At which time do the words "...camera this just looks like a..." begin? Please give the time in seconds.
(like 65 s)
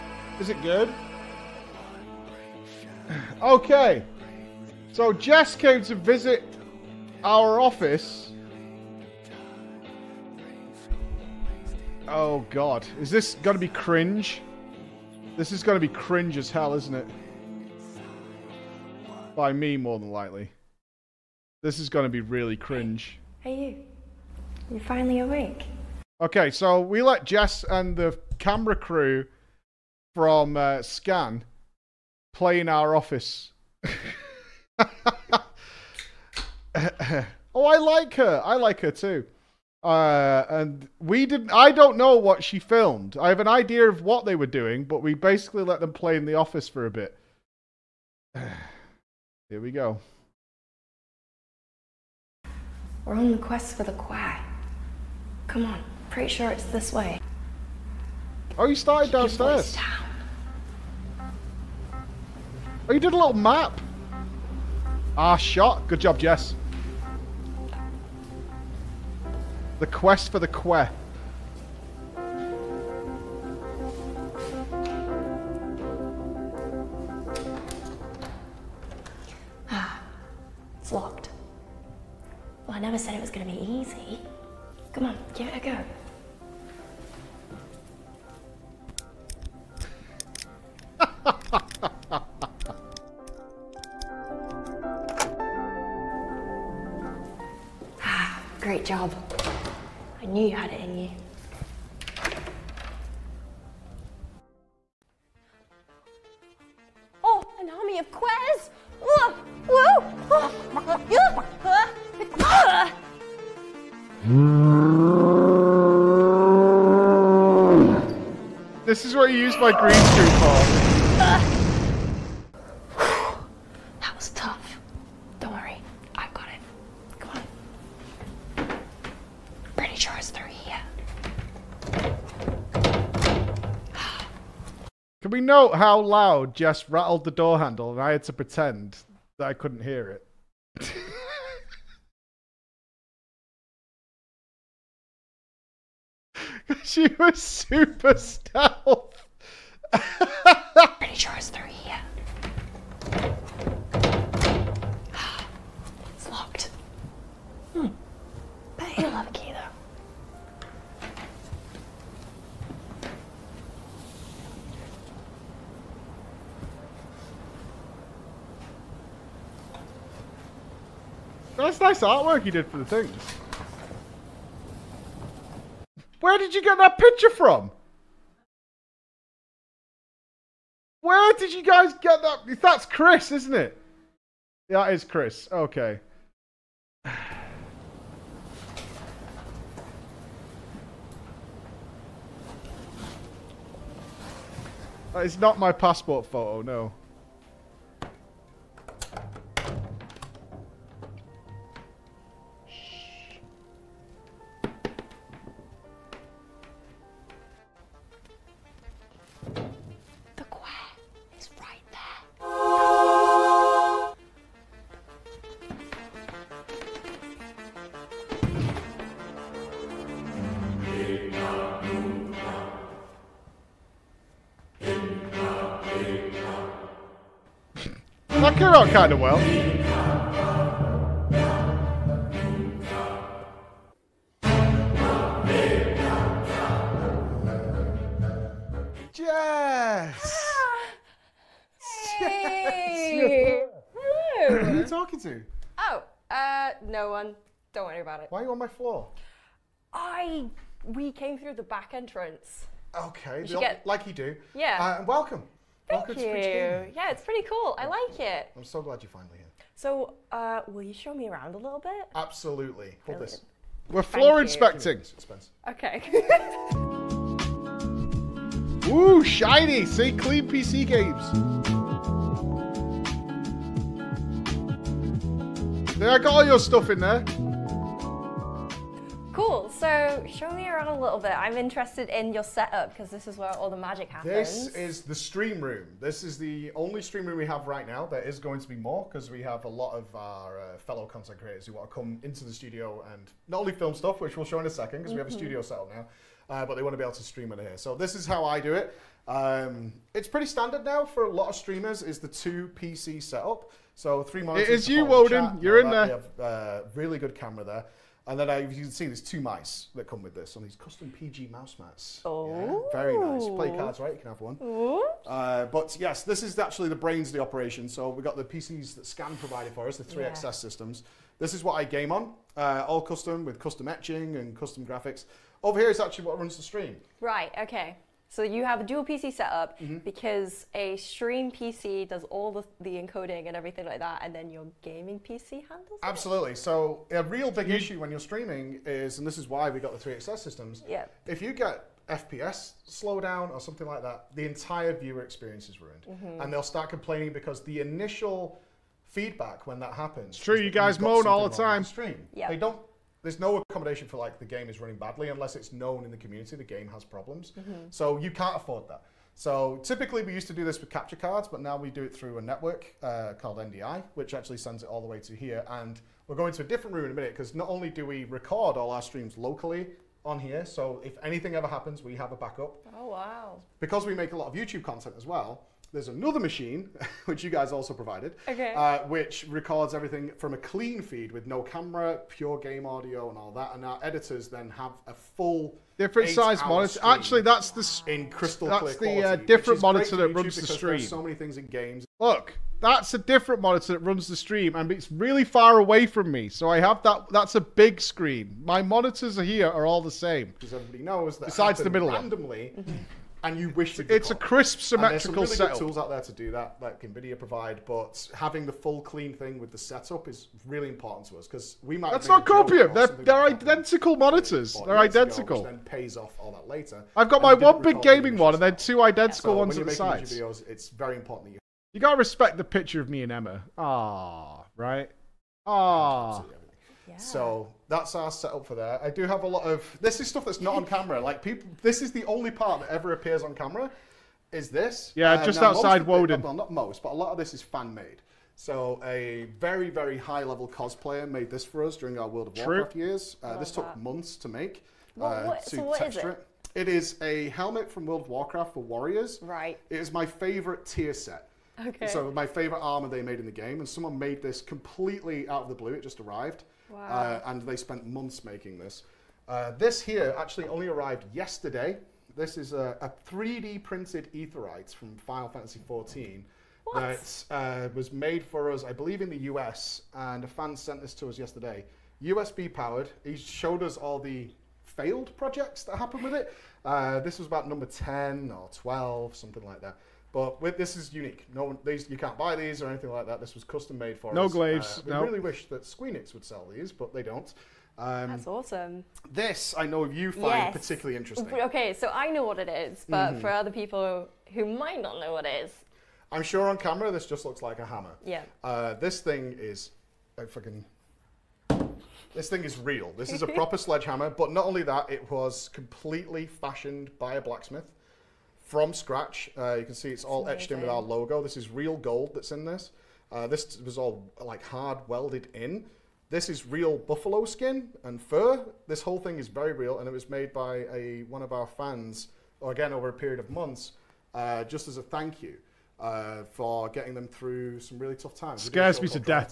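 496 s.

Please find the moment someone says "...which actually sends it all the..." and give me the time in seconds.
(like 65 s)
364 s.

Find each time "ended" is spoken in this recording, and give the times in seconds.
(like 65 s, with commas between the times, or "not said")
not said.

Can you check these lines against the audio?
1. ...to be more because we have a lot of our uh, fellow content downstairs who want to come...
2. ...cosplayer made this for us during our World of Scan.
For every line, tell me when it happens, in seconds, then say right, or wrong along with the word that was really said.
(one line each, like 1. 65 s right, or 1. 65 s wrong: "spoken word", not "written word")
1. 288 s wrong: "creators", not "downstairs"
2. 440 s wrong: "True", not "Scan".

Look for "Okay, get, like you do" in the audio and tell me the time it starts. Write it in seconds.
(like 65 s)
253 s.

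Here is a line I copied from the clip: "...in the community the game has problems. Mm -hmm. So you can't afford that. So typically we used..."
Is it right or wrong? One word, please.
right.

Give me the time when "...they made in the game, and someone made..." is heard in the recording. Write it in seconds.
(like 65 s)
453 s.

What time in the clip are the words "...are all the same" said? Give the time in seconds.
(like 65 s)
399 s.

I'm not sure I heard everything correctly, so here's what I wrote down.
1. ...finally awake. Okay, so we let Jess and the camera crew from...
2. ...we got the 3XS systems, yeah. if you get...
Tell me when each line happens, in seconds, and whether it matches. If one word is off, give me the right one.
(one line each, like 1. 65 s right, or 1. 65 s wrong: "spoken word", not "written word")
1. 24 s right
2. 339 s right.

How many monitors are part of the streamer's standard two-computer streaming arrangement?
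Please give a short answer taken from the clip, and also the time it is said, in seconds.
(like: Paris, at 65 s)
3, at 304 s.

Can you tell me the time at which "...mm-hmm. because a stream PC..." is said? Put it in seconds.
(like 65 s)
329 s.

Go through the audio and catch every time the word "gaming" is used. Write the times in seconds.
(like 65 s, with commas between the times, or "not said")
334 s, 418 s.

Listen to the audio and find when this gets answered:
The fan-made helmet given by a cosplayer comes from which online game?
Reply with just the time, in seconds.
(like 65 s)
448 s.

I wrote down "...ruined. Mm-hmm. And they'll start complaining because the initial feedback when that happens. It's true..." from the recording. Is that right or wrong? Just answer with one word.
right.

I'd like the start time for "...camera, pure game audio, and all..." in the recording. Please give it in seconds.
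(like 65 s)
381 s.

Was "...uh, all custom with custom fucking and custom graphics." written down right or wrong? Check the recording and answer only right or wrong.
wrong.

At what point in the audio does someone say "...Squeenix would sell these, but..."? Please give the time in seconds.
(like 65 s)
485 s.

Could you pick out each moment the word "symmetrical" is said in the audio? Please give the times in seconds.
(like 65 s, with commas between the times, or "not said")
404 s.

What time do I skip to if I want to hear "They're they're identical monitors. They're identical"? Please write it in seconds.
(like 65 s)
412 s.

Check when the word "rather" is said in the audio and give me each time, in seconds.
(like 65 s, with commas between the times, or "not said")
not said.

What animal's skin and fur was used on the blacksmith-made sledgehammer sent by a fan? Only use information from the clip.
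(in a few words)
Buffalo.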